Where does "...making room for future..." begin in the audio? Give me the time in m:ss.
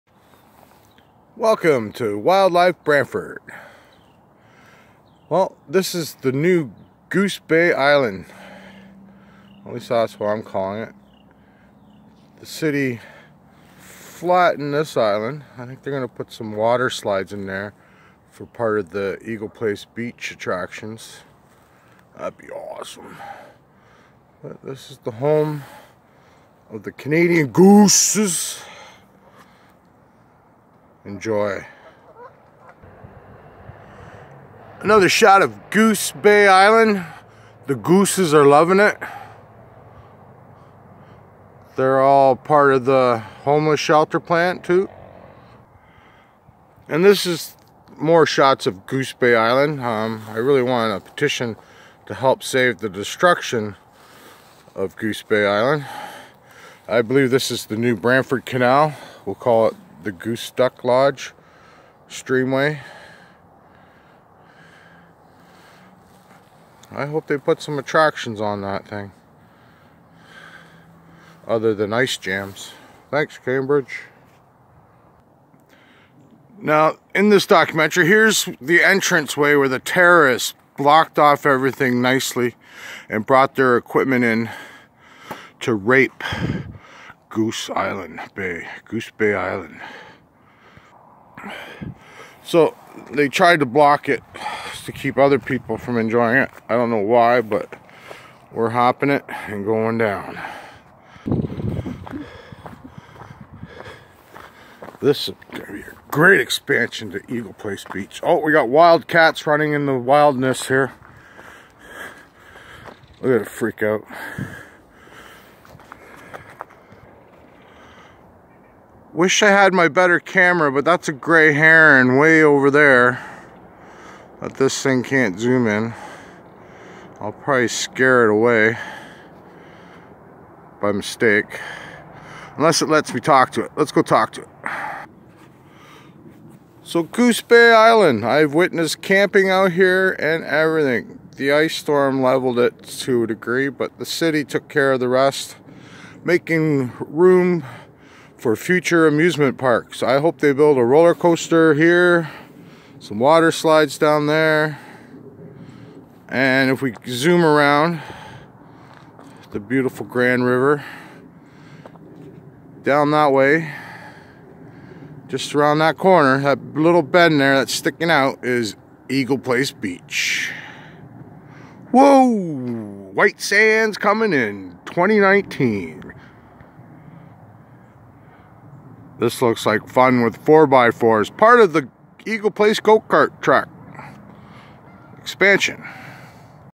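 2:26.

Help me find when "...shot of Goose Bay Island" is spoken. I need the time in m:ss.
0:35.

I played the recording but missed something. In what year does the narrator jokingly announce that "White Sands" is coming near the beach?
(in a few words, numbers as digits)
2019.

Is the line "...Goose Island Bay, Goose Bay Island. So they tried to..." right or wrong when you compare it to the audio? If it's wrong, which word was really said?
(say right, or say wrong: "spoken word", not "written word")
right.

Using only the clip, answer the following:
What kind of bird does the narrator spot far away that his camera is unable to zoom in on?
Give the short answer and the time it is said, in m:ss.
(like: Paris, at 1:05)
gray heron, at 2:01.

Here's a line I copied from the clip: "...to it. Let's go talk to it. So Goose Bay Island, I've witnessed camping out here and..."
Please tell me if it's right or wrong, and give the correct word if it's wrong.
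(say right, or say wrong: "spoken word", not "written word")
right.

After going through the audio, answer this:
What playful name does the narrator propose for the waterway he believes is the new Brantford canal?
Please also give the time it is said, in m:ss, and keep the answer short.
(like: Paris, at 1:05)
Goose Duck Lodge streamway, at 1:00.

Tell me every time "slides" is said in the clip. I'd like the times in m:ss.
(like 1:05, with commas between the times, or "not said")
0:16, 2:33.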